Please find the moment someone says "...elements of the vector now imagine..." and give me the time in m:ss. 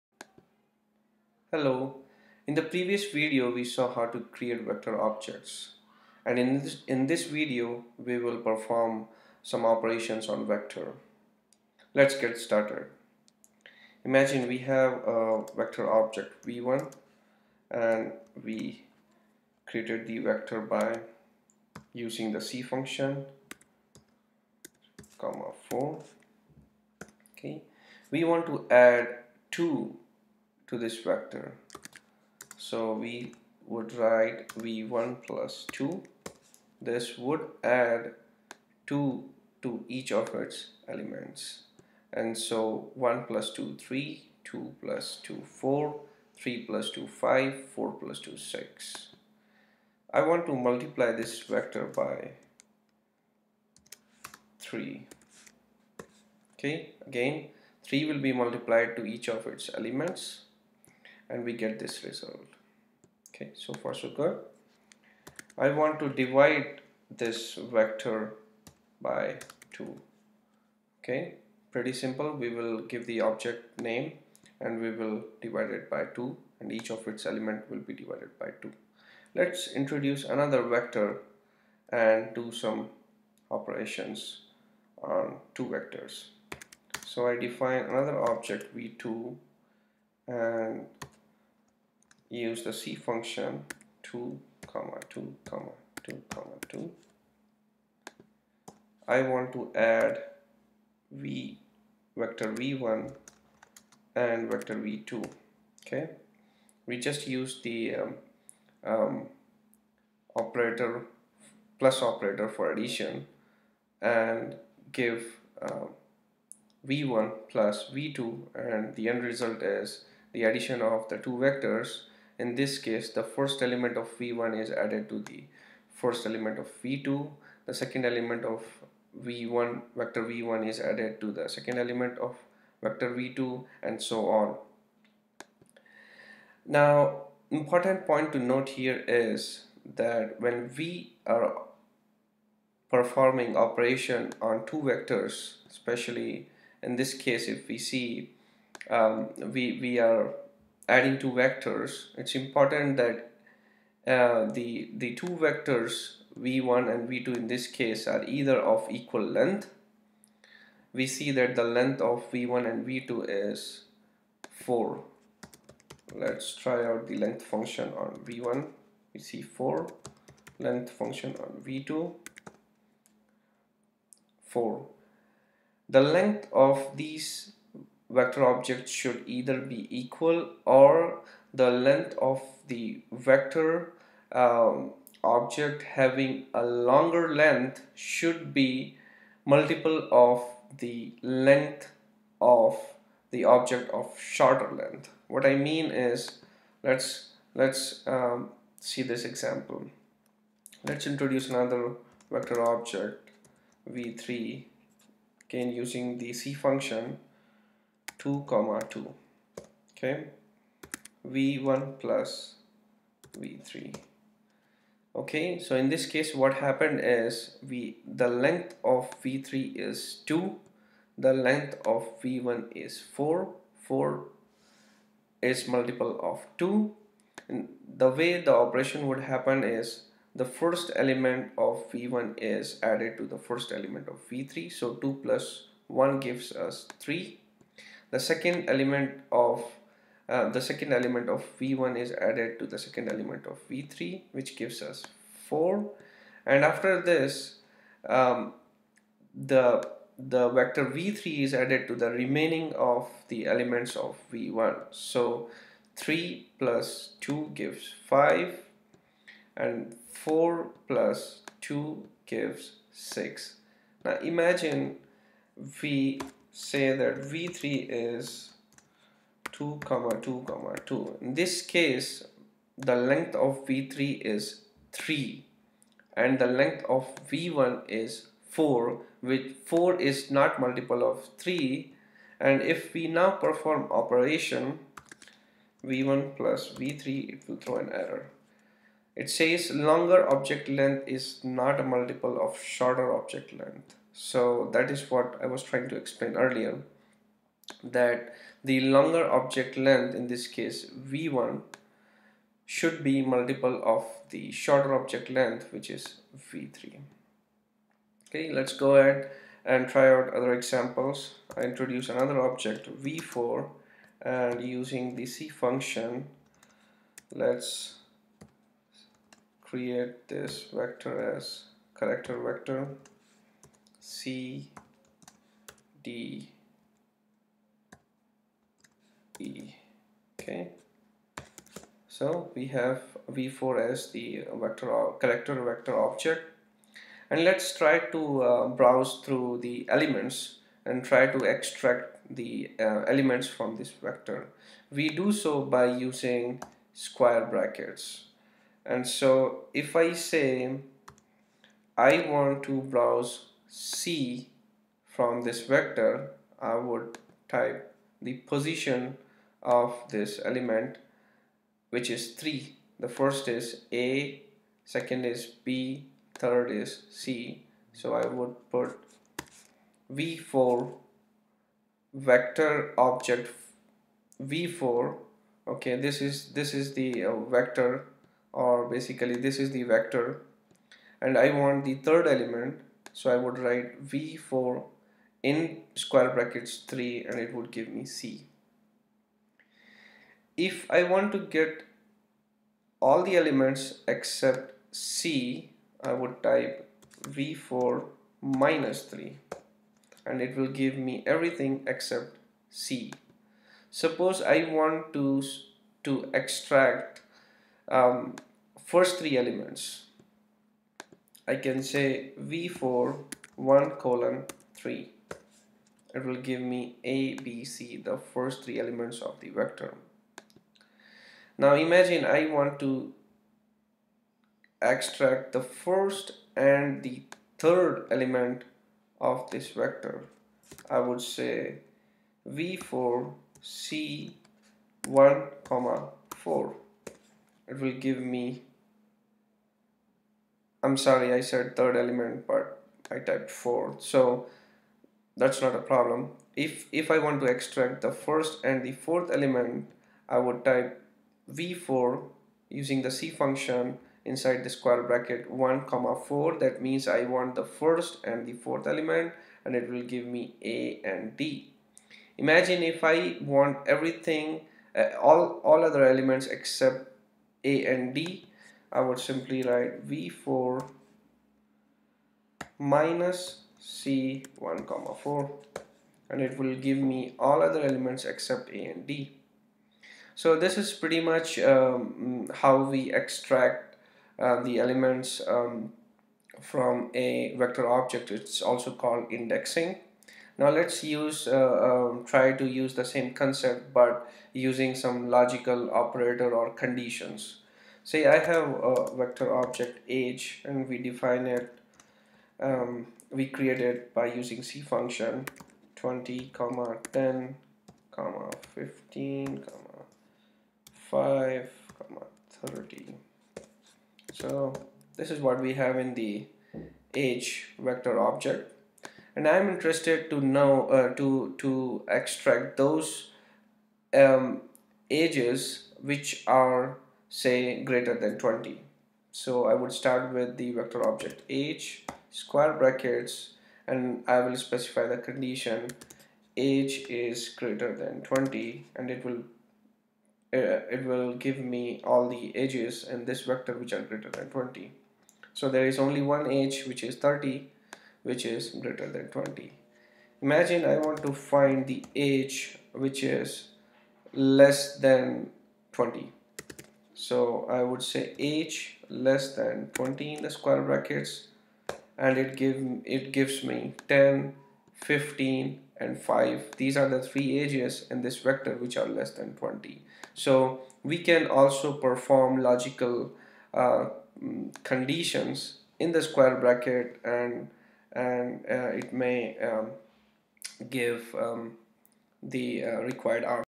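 6:58.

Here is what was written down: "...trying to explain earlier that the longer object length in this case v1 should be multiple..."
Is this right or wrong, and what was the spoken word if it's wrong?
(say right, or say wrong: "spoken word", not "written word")
right.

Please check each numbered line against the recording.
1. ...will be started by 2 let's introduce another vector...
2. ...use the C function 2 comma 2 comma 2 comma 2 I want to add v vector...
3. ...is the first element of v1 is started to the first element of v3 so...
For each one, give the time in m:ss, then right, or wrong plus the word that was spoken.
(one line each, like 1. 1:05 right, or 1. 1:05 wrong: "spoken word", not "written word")
1. 1:17 wrong: "divided", not "started"
2. 1:32 right
3. 3:49 wrong: "added", not "started".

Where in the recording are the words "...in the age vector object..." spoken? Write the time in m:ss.
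8:35.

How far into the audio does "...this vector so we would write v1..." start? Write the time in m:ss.
0:30.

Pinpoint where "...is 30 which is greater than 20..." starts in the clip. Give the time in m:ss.
9:07.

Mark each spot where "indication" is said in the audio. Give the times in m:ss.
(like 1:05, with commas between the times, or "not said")
not said.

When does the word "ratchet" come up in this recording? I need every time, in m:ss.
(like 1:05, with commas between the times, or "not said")
not said.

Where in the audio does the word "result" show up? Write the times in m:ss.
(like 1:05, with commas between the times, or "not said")
1:02, 1:59.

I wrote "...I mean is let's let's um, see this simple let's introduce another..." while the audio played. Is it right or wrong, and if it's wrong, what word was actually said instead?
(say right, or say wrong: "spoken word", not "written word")
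wrong: "example", not "simple".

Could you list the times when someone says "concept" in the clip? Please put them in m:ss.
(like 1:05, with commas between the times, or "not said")
8:13.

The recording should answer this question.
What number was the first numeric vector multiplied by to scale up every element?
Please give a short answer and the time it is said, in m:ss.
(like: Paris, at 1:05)
3, at 0:50.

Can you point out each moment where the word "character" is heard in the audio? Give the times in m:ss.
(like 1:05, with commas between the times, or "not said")
5:21, 5:35.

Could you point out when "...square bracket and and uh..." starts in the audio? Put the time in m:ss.
9:36.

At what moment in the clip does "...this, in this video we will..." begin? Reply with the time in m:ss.
0:06.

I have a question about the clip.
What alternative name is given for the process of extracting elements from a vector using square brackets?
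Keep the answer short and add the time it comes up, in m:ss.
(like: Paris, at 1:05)
indexing, at 8:09.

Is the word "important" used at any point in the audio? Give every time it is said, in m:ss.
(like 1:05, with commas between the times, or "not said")
2:17, 2:32.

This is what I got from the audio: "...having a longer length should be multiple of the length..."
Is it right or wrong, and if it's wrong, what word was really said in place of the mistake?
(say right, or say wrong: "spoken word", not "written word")
right.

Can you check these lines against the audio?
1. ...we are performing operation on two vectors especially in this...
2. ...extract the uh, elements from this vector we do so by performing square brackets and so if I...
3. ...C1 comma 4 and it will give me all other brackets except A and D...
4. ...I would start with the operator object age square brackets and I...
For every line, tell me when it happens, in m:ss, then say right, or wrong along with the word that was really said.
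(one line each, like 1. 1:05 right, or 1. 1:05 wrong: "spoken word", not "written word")
1. 2:20 right
2. 5:41 wrong: "using", not "performing"
3. 7:53 wrong: "elements", not "brackets"
4. 8:49 wrong: "vector", not "operator".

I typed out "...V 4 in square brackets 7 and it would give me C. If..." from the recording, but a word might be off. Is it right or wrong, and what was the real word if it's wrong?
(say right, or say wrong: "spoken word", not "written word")
wrong: "3", not "7".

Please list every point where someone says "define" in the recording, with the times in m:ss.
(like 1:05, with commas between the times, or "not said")
1:27, 8:20.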